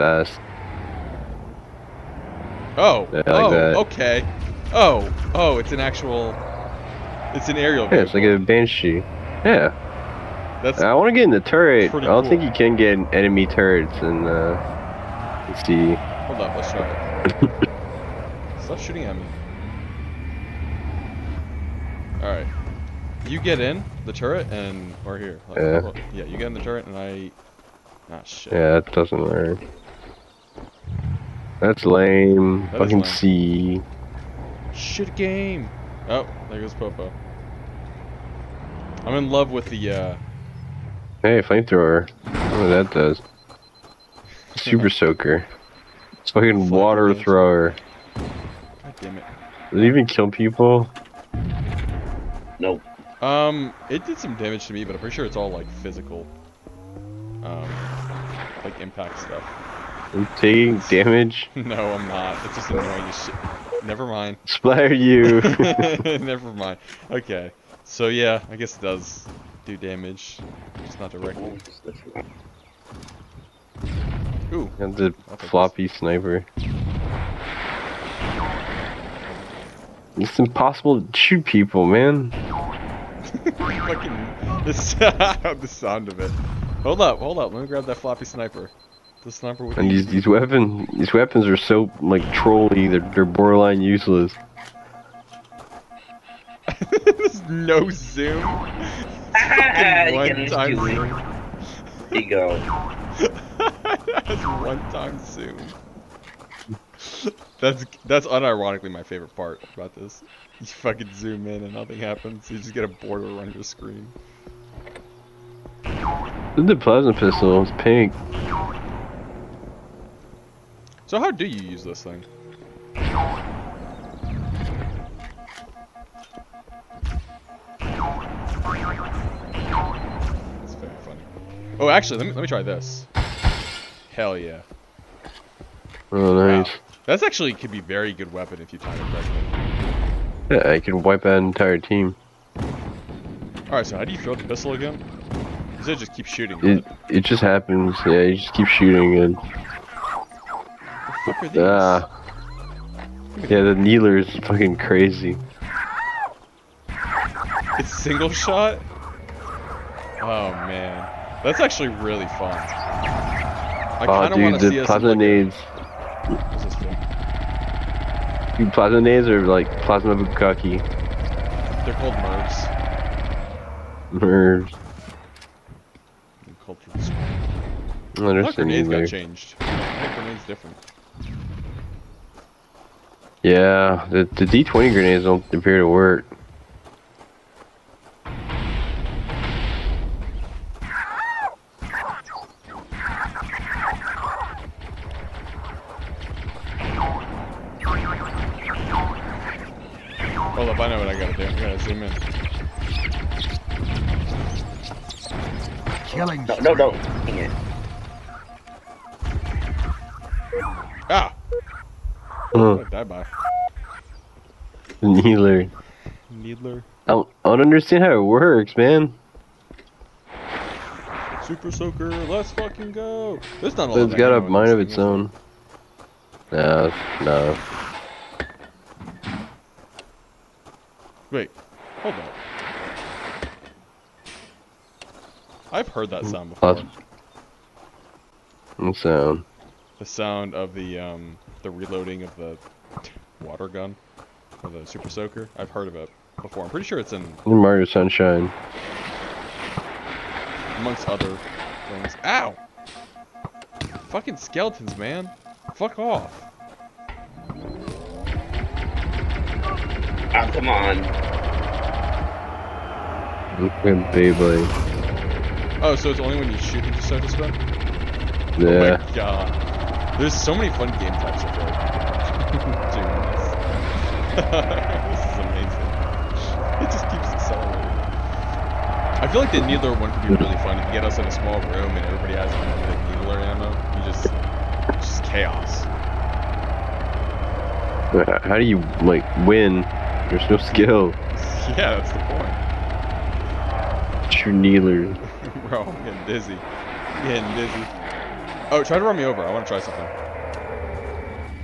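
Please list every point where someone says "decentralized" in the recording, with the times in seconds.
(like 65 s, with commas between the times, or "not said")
not said.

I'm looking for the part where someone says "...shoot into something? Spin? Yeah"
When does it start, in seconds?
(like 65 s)
266 s.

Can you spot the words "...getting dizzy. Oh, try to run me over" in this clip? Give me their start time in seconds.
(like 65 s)
297 s.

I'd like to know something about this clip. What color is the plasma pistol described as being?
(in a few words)
Pink.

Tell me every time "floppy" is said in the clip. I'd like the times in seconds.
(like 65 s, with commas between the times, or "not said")
75 s, 87 s.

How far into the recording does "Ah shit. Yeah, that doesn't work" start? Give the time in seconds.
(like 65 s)
28 s.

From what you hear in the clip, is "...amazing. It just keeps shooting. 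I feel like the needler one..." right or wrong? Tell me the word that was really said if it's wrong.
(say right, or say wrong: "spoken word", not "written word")
wrong: "accelerating", not "shooting".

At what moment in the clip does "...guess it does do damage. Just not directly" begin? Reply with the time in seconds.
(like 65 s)
68 s.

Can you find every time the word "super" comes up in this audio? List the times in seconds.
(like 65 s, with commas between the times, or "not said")
44 s, 221 s, 244 s.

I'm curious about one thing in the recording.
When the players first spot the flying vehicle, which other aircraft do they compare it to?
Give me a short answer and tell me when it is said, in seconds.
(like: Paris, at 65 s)
Banshee, at 8 s.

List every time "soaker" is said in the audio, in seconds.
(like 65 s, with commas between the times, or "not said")
44 s, 221 s, 245 s.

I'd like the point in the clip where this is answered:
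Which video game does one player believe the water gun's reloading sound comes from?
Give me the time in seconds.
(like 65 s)
247 s.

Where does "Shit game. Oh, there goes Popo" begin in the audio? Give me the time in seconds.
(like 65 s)
34 s.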